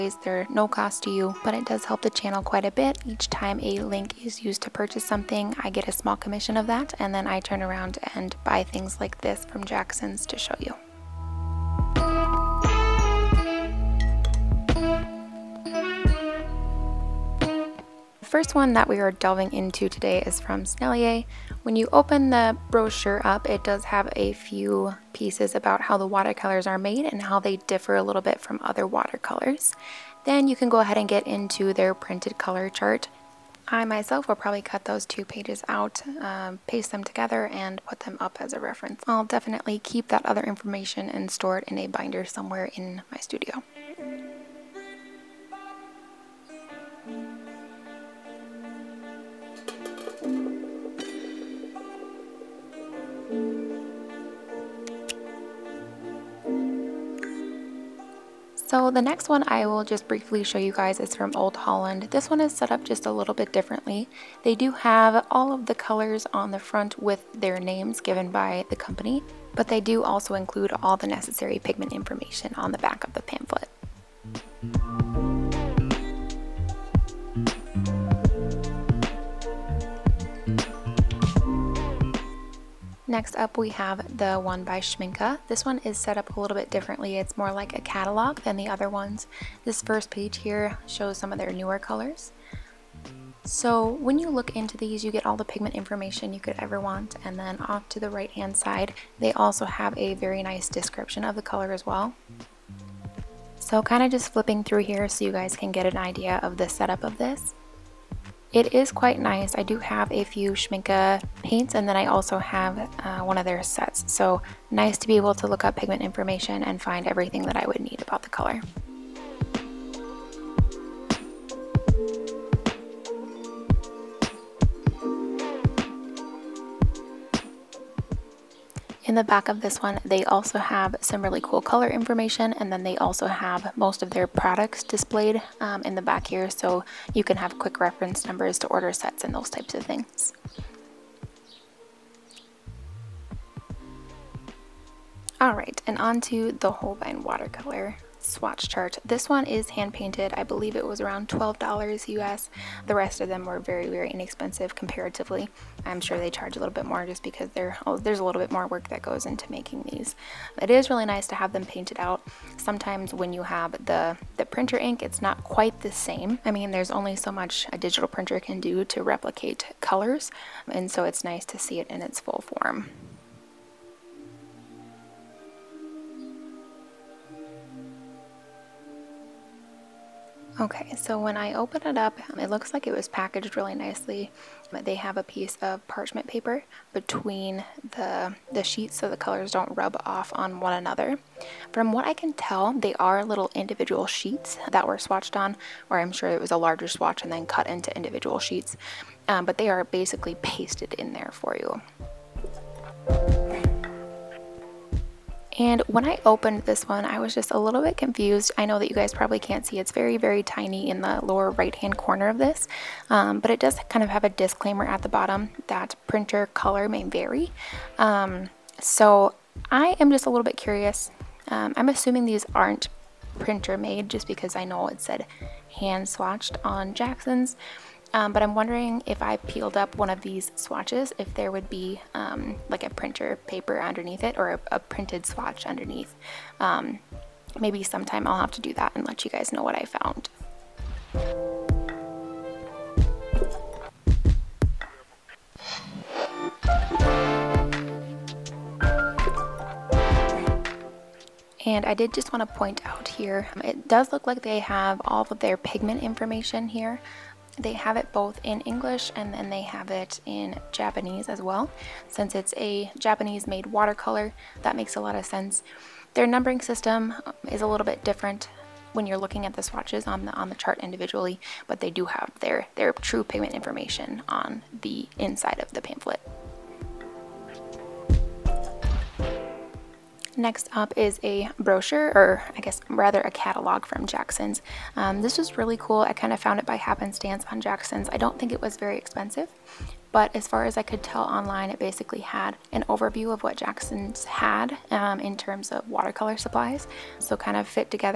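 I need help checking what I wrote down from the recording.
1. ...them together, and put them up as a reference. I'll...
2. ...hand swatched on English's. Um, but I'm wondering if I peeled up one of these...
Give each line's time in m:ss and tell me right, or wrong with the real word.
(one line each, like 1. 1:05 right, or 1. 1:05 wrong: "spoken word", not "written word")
1. 0:36 right
2. 3:45 wrong: "Jackson", not "English".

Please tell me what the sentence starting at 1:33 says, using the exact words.
So when you look into these, you get all the pigment information you could ever want.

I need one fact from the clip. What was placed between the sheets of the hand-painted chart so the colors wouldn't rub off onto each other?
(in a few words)
Parchment paper.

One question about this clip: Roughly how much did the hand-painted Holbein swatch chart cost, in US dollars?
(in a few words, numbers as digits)
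$12.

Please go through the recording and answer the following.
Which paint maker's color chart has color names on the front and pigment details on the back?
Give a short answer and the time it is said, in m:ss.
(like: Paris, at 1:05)
Old Holland, at 1:01.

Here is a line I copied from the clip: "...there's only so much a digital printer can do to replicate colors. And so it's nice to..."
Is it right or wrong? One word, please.
right.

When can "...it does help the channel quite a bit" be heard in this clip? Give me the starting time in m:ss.
0:01.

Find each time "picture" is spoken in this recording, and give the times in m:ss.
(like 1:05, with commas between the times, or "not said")
not said.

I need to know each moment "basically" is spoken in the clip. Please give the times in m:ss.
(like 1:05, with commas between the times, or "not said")
3:19, 4:51.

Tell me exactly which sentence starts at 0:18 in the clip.
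first one that we are delving into today is from Sennelier.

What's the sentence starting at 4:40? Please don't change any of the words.
Next up is a brochure, or I guess rather a catalog from Jackson's.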